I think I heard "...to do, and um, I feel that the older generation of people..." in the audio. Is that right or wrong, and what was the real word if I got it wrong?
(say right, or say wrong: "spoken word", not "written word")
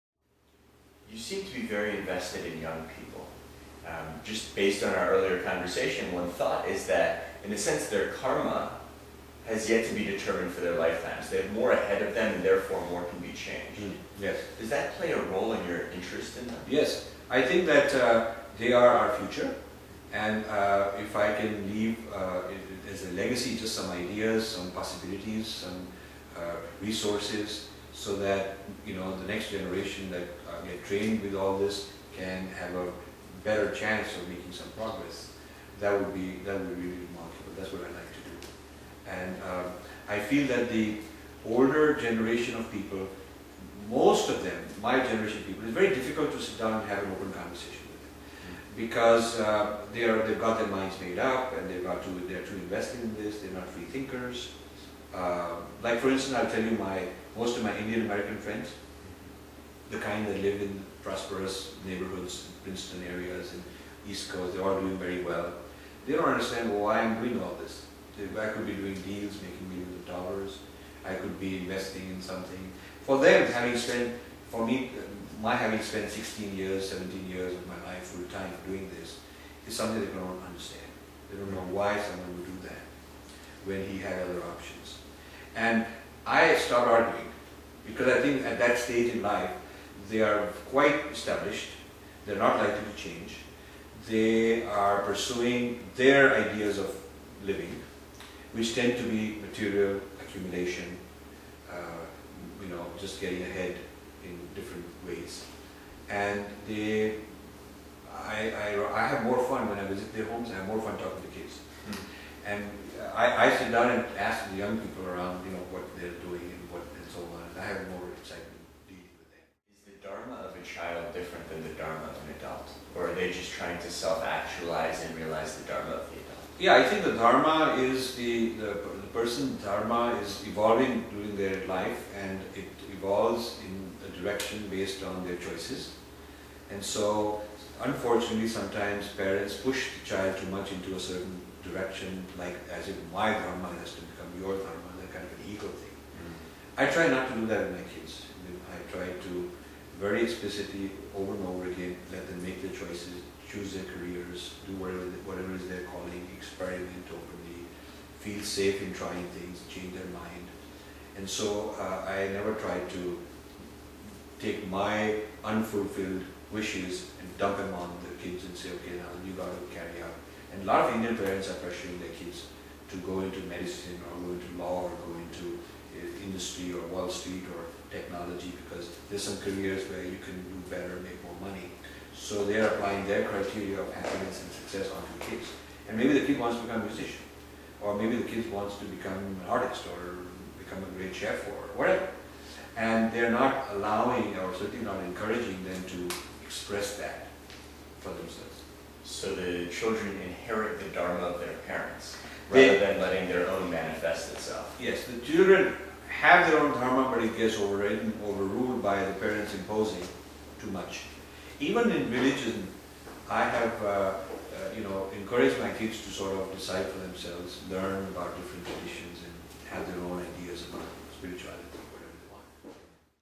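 right.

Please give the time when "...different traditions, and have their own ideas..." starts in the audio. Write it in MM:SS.
03:38.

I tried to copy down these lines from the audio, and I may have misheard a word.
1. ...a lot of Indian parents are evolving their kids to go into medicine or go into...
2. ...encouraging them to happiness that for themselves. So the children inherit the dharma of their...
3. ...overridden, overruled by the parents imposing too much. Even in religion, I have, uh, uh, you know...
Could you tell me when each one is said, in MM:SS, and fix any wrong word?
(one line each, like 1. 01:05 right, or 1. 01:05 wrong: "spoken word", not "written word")
1. 02:50 wrong: "pressuring", not "evolving"
2. 03:15 wrong: "express", not "happiness"
3. 03:27 right.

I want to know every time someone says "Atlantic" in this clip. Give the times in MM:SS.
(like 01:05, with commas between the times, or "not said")
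not said.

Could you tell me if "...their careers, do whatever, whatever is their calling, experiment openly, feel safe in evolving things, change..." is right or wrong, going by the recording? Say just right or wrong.
wrong.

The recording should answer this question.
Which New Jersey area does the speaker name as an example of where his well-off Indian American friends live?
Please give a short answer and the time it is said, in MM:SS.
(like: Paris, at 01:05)
Princeton, at 01:02.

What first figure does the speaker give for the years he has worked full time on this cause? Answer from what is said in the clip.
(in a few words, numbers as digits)
16.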